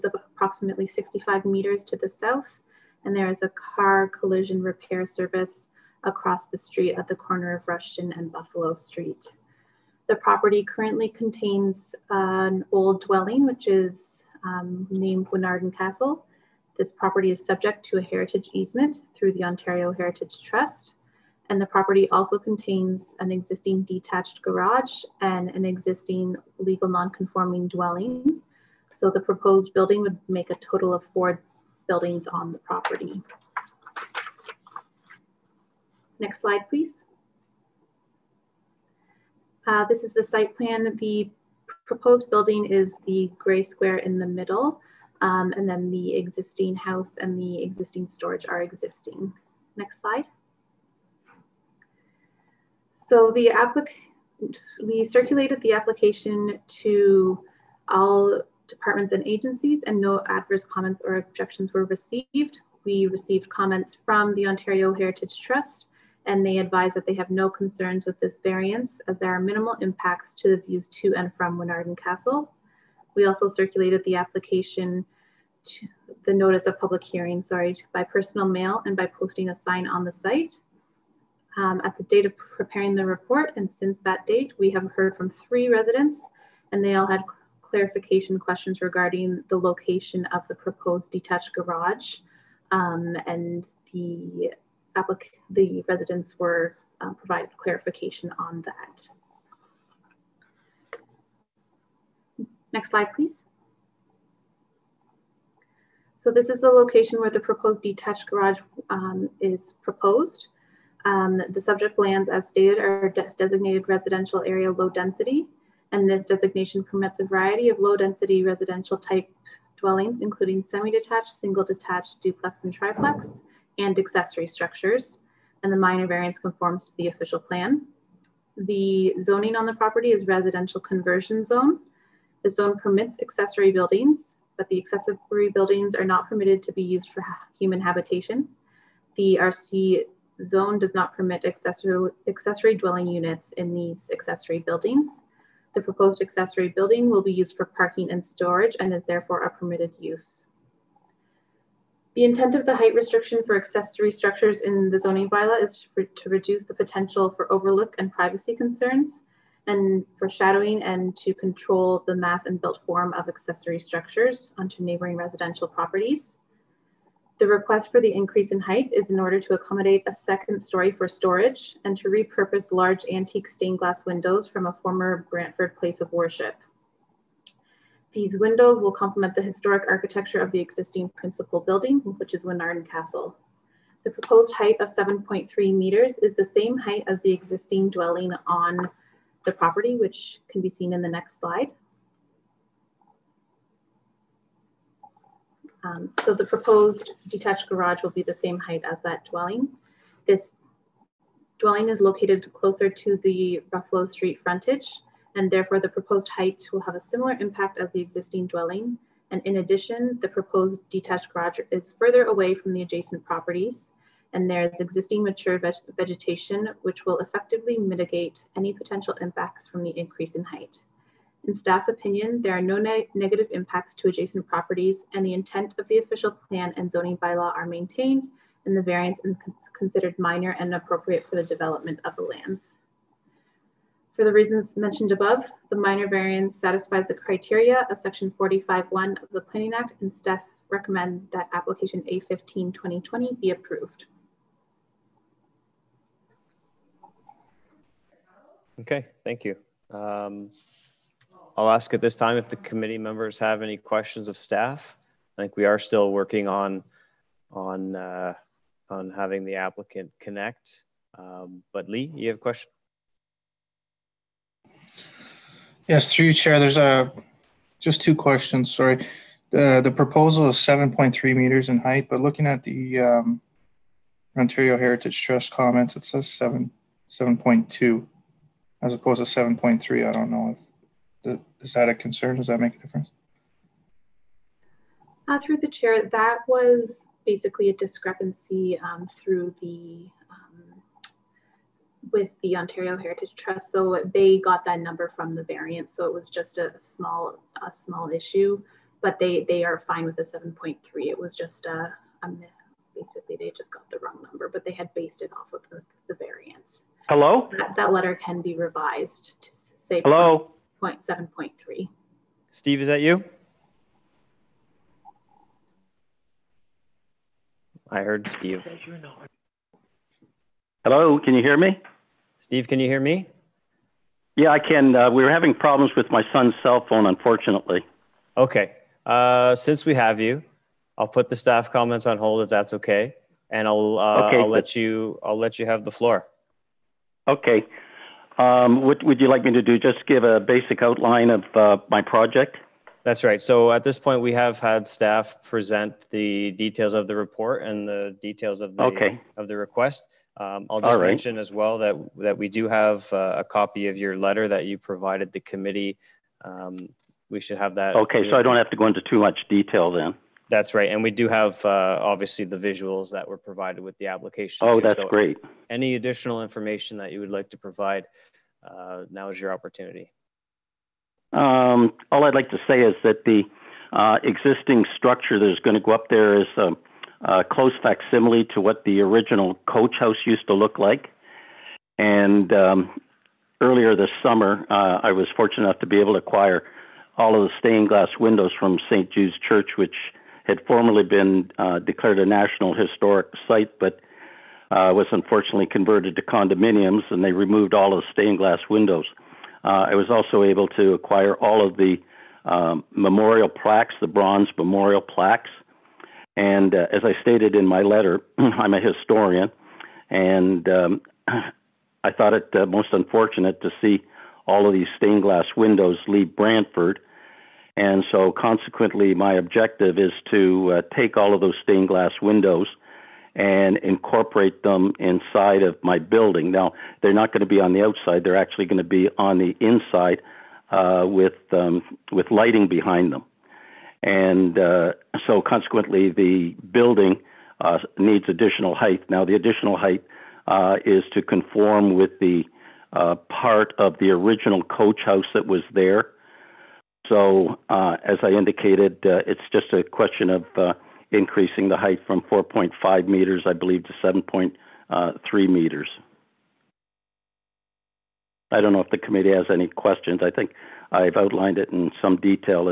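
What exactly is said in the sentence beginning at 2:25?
The proposed accessory building will be used for parking and storage and is therefore a permitted use.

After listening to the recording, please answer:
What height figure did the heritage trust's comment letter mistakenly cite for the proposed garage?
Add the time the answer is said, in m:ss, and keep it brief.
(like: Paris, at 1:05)
7.2, at 4:37.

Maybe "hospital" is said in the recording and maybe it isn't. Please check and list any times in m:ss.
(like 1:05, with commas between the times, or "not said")
not said.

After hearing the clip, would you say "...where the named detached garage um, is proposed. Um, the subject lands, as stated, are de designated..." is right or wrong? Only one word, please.
wrong.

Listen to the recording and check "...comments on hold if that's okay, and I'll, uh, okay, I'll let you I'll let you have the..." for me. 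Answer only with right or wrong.
right.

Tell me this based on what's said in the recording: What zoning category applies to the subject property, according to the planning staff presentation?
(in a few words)
Residential conversion zone.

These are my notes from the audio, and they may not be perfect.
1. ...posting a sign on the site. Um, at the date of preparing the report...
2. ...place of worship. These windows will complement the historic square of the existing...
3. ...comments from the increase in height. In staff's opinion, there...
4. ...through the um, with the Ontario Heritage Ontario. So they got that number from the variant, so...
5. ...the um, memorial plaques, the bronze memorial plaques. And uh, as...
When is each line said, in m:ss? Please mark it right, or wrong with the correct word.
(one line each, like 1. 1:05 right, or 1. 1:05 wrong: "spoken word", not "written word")
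1. 1:19 right
2. 2:55 wrong: "architecture", not "square"
3. 3:39 wrong: "impacts", not "comments"
4. 4:49 wrong: "Trust", not "Ontario"
5. 6:41 right.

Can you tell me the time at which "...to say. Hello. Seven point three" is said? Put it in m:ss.
5:09.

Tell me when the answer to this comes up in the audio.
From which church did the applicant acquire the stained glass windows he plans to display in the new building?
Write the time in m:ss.
6:28.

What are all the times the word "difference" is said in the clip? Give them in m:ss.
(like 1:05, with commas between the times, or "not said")
4:42.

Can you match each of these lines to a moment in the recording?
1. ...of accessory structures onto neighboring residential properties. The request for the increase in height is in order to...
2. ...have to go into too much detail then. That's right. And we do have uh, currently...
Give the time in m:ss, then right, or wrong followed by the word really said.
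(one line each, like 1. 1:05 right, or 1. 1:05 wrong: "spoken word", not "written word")
1. 2:43 right
2. 5:58 wrong: "obviously", not "currently".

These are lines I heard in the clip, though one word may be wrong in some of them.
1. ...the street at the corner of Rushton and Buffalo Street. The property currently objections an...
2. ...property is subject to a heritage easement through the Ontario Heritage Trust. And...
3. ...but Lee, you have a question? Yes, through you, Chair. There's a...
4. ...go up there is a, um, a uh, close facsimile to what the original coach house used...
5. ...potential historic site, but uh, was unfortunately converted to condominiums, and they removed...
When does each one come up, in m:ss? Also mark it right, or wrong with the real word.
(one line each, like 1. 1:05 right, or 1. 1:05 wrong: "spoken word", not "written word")
1. 0:06 wrong: "contains", not "objections"
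2. 0:16 right
3. 4:21 right
4. 6:15 right
5. 6:32 wrong: "national", not "potential".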